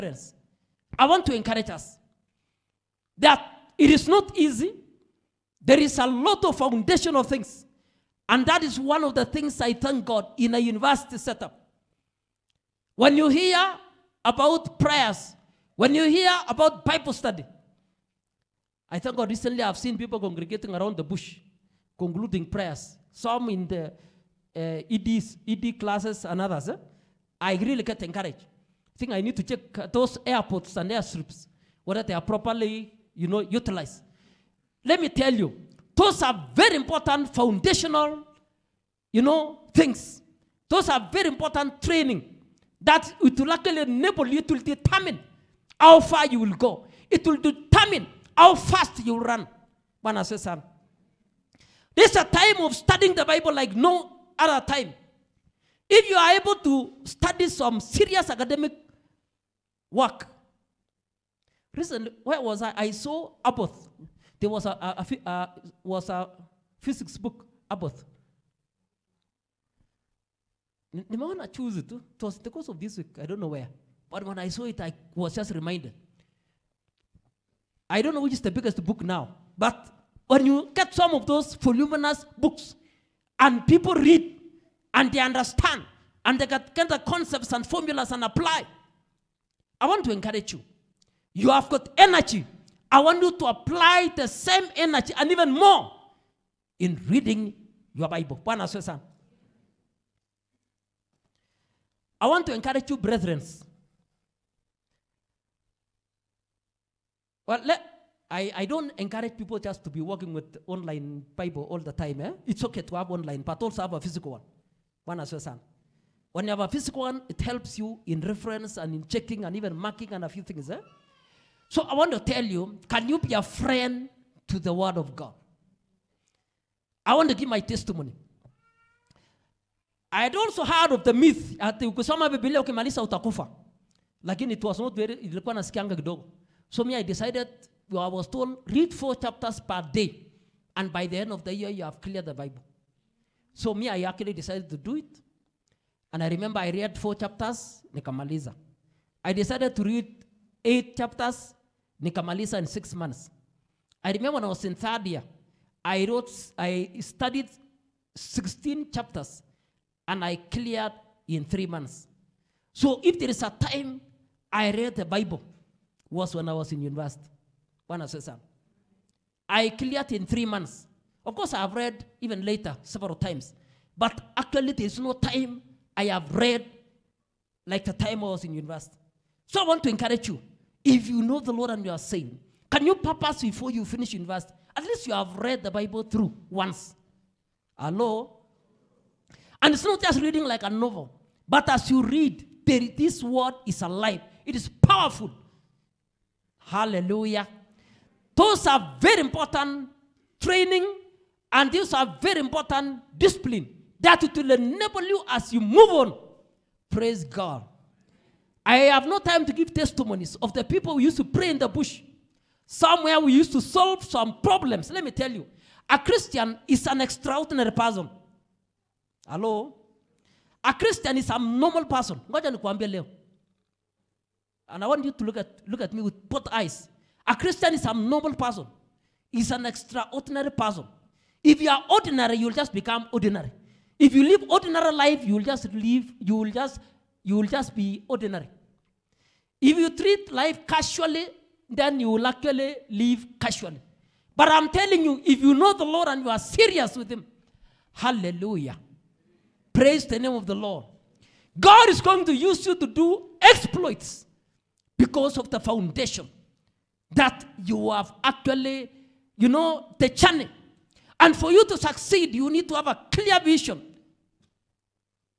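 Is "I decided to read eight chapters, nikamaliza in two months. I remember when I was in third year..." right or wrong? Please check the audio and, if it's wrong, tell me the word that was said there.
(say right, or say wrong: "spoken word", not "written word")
wrong: "six", not "two".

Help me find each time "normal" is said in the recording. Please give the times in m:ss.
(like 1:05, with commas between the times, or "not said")
3:41, 3:47.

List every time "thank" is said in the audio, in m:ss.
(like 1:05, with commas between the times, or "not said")
0:09, 0:18.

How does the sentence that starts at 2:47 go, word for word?
Bwana asifiwe I cleared in three months.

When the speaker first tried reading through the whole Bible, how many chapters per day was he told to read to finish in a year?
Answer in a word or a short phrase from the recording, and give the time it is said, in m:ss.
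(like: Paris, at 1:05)
4, at 2:18.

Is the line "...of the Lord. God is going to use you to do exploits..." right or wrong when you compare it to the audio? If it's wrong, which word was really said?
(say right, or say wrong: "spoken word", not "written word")
right.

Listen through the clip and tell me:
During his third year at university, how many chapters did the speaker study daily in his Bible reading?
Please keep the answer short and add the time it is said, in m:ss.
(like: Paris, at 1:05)
16, at 2:38.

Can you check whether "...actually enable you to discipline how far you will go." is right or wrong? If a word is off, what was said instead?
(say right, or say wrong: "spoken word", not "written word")
wrong: "determine", not "discipline".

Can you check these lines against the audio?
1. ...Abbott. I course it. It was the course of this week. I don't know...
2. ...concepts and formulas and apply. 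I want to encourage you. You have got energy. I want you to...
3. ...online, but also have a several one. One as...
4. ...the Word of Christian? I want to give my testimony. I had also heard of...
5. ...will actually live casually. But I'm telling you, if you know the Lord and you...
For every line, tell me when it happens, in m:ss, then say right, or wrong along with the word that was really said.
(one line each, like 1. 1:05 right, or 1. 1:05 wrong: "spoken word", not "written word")
1. 1:07 wrong: "choose", not "course"
2. 1:27 right
3. 1:53 wrong: "physical", not "several"
4. 2:04 wrong: "God", not "Christian"
5. 4:02 right.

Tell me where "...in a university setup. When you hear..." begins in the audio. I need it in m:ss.
0:10.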